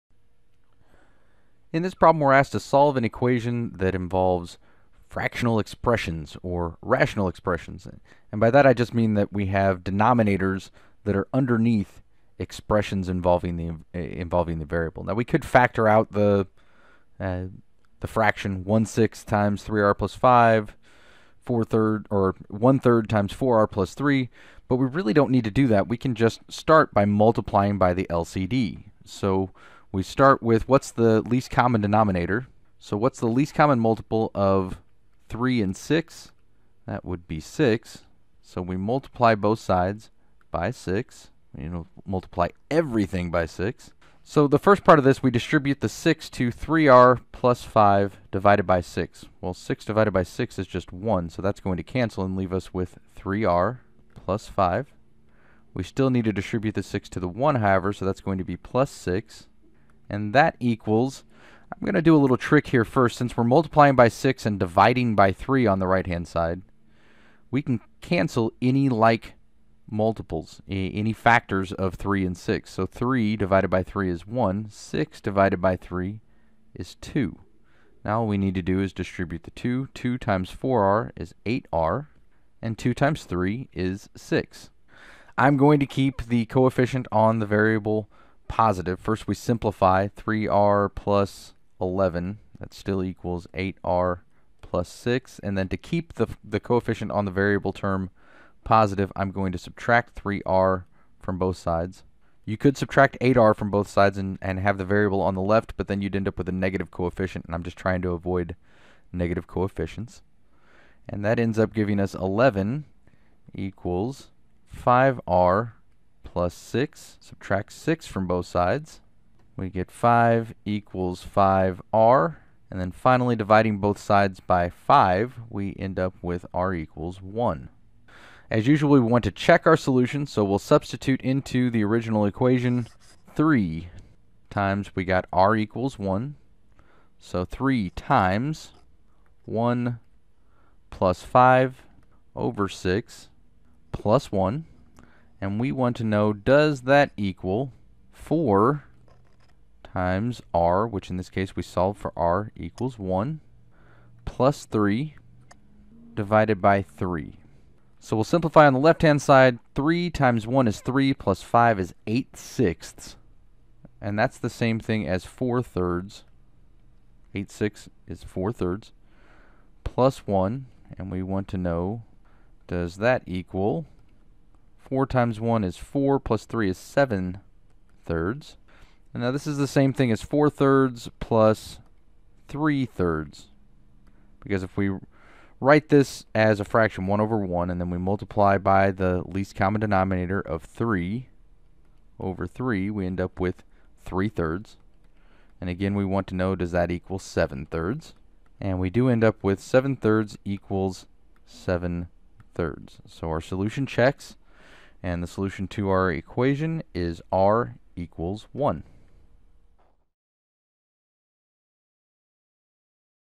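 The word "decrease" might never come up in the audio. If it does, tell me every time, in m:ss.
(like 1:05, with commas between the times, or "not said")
not said.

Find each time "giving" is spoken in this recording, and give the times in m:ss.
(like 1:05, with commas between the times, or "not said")
1:51.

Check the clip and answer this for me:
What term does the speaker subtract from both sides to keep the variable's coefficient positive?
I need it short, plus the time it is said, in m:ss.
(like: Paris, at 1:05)
3r, at 1:39.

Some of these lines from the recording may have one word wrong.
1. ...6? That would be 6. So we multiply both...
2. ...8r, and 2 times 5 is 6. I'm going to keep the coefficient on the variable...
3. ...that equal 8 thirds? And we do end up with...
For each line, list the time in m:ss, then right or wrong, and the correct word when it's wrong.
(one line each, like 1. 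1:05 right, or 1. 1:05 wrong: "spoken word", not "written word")
1. 0:35 right
2. 1:21 wrong: "3", not "5"
3. 3:16 wrong: "7", not "8".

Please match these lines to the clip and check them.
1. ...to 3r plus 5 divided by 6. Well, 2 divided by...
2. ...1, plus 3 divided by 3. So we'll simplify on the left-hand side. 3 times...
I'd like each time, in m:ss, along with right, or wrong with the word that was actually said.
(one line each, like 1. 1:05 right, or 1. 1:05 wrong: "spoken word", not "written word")
1. 0:46 wrong: "6", not "2"
2. 2:32 right.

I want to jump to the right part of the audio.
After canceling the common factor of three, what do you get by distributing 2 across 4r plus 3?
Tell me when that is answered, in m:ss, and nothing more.
1:33.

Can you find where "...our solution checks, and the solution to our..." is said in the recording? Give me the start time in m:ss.
3:23.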